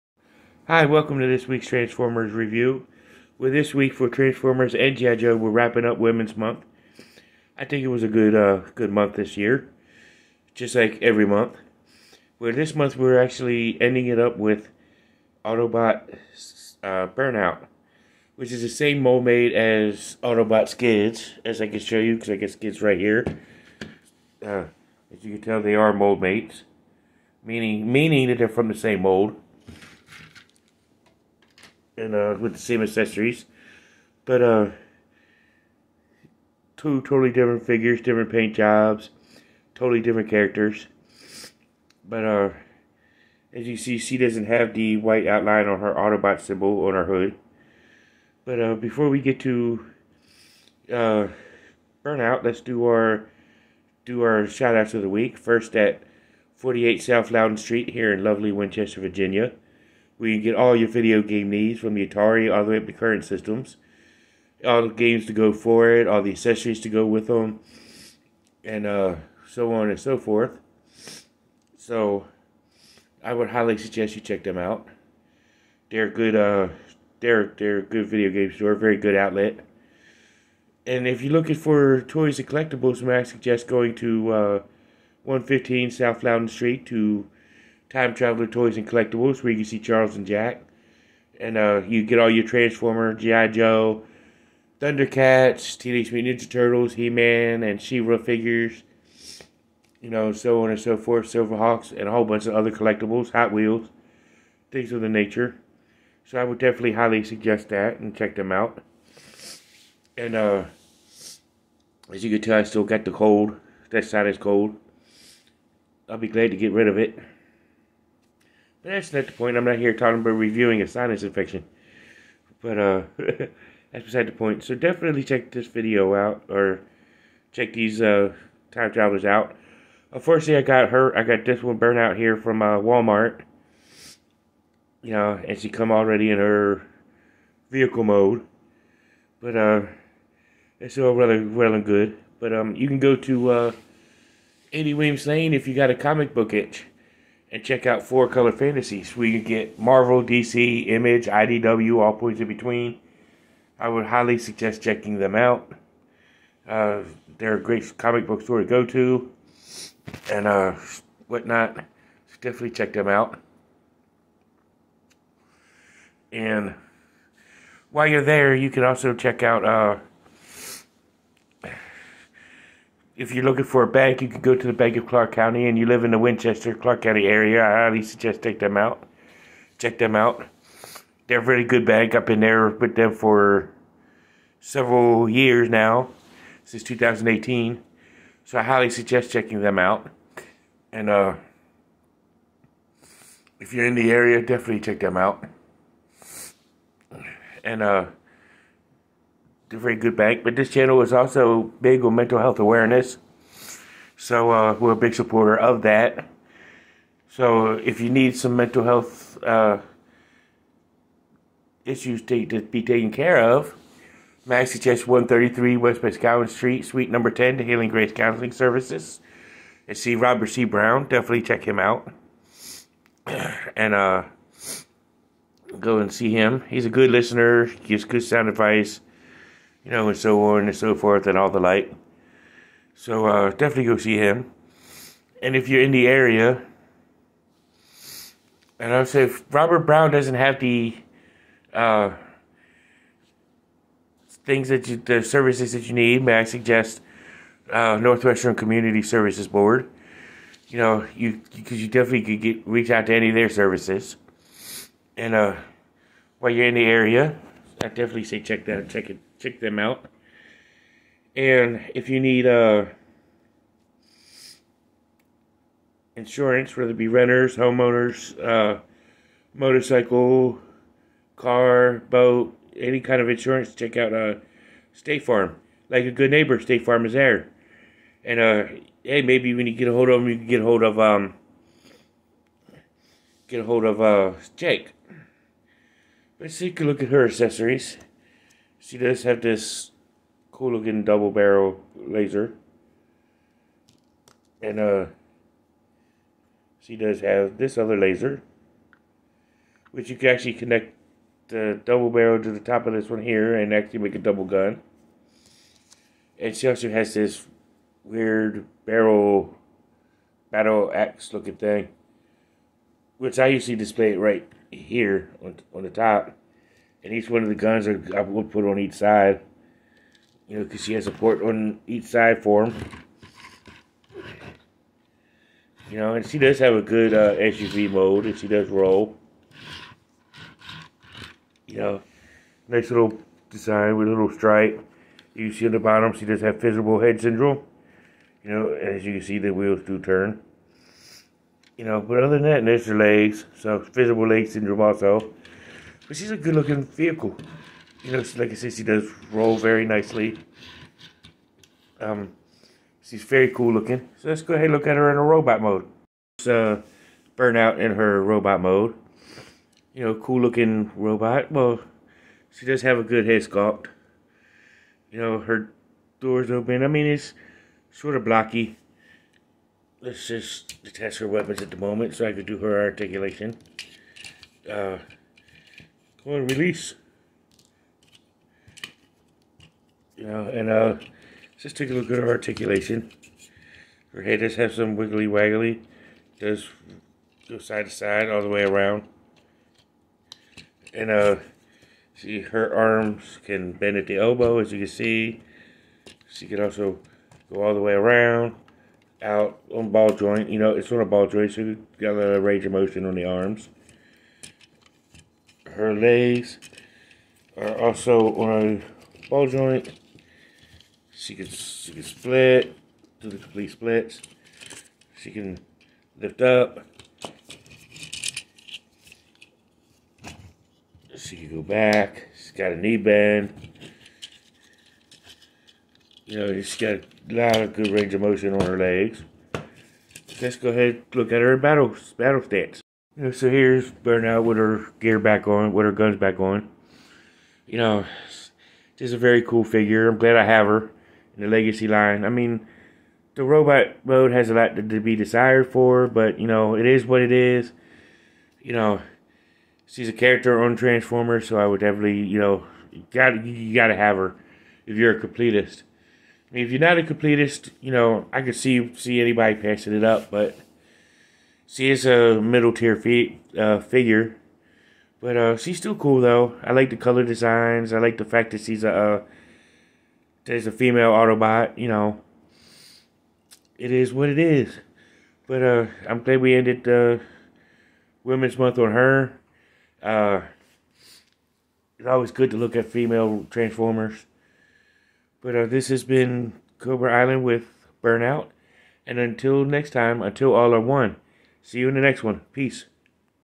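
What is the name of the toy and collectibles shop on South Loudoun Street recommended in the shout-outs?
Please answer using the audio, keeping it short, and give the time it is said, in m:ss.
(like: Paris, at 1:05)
Time Traveler Toys and Collectibles, at 1:27.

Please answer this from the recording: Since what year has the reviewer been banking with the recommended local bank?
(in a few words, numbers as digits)
2018.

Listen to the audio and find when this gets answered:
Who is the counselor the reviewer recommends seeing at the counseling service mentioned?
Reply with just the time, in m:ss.
3:40.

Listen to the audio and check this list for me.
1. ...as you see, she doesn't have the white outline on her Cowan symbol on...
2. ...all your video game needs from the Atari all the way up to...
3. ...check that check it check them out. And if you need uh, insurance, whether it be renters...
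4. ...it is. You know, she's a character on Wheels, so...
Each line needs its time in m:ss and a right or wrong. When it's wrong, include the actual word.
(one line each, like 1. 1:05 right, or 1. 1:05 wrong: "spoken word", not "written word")
1. 0:43 wrong: "Autobot", not "Cowan"
2. 1:00 right
3. 4:18 right
4. 7:27 wrong: "Transformers", not "Wheels".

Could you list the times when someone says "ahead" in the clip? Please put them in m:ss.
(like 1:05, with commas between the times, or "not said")
5:54, 7:10.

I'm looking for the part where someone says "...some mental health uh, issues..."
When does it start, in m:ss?
3:28.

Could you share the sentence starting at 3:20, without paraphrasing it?
But this channel is also big on mental health awareness.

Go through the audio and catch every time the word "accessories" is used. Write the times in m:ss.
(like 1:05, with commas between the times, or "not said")
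0:32, 1:06, 4:47.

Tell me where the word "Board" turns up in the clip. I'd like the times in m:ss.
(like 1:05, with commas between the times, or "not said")
4:09.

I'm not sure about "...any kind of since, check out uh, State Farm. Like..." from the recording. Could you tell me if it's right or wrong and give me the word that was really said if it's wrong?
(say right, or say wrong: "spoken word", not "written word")
wrong: "insurance", not "since".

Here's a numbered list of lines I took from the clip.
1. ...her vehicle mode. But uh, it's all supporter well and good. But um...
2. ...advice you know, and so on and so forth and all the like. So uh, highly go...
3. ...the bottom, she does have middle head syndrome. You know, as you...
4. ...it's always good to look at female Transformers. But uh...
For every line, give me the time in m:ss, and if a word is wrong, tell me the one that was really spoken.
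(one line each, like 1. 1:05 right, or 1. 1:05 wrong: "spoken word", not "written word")
1. 2:16 wrong: "rather", not "supporter"
2. 3:48 wrong: "definitely", not "highly"
3. 5:35 wrong: "visible", not "middle"
4. 8:01 right.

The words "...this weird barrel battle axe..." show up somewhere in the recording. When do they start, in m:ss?
5:07.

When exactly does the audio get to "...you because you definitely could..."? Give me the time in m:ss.
4:11.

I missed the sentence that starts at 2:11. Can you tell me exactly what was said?
I got this one burnt out here from uh, Walmart.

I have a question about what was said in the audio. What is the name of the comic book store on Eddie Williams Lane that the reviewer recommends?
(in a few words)
Four Color Fantasies.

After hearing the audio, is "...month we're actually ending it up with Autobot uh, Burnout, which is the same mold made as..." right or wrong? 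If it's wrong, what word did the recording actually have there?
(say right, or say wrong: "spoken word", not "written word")
right.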